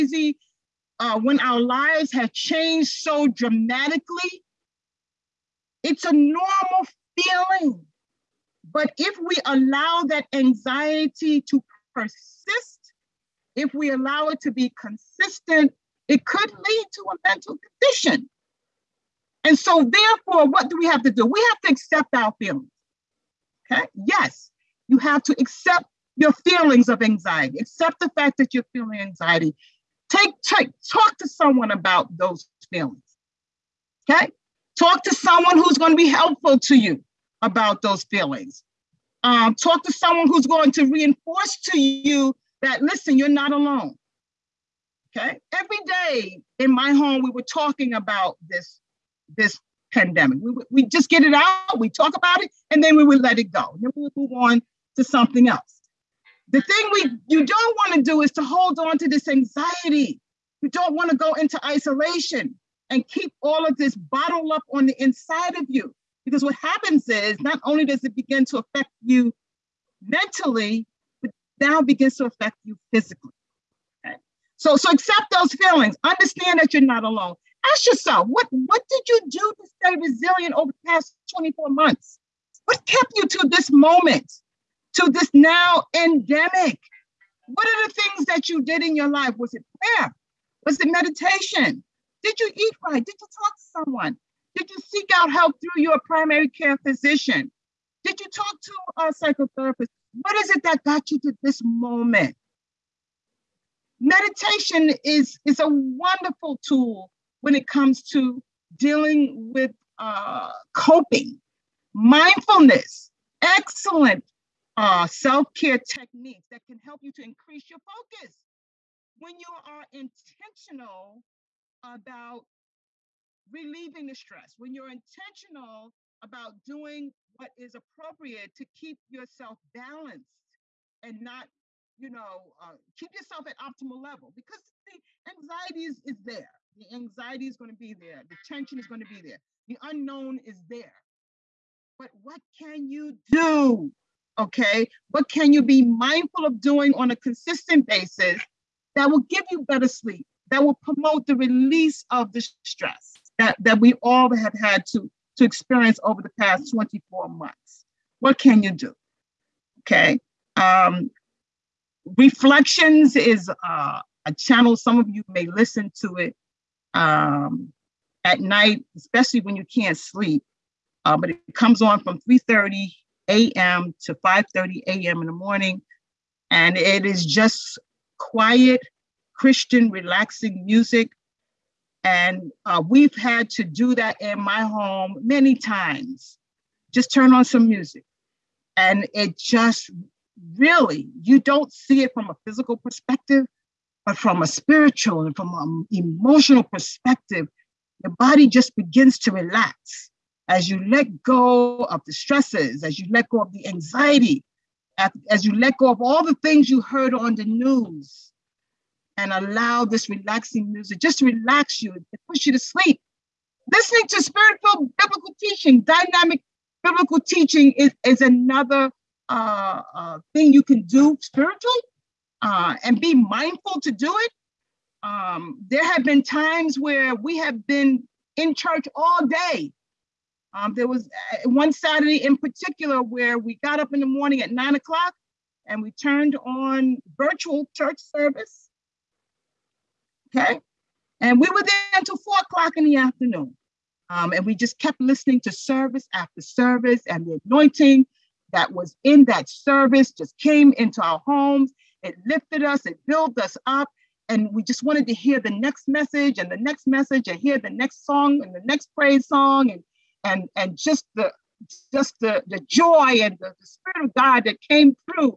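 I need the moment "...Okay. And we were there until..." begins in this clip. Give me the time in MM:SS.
04:00.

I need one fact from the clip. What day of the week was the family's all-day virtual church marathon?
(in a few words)
Saturday.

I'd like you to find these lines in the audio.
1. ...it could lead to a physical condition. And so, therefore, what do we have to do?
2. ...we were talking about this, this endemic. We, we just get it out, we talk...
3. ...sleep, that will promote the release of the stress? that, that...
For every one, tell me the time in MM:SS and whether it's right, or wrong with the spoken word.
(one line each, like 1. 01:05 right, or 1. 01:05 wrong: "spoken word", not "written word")
1. 00:16 wrong: "mental", not "physical"
2. 00:47 wrong: "pandemic", not "endemic"
3. 02:29 right.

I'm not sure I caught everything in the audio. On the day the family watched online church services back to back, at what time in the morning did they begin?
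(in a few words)
9:00.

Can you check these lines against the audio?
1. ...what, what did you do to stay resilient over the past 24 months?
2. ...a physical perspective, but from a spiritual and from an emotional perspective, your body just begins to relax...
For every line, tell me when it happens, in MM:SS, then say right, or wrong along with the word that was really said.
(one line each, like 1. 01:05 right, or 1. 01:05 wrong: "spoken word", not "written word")
1. 01:18 right
2. 03:12 right.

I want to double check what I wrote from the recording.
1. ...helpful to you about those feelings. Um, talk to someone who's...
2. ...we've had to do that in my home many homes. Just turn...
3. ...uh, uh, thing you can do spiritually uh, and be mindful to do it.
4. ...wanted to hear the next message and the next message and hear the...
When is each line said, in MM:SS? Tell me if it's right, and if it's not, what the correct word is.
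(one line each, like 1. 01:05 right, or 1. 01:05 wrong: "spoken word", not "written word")
1. 00:36 right
2. 03:02 wrong: "times", not "homes"
3. 03:39 right
4. 04:14 right.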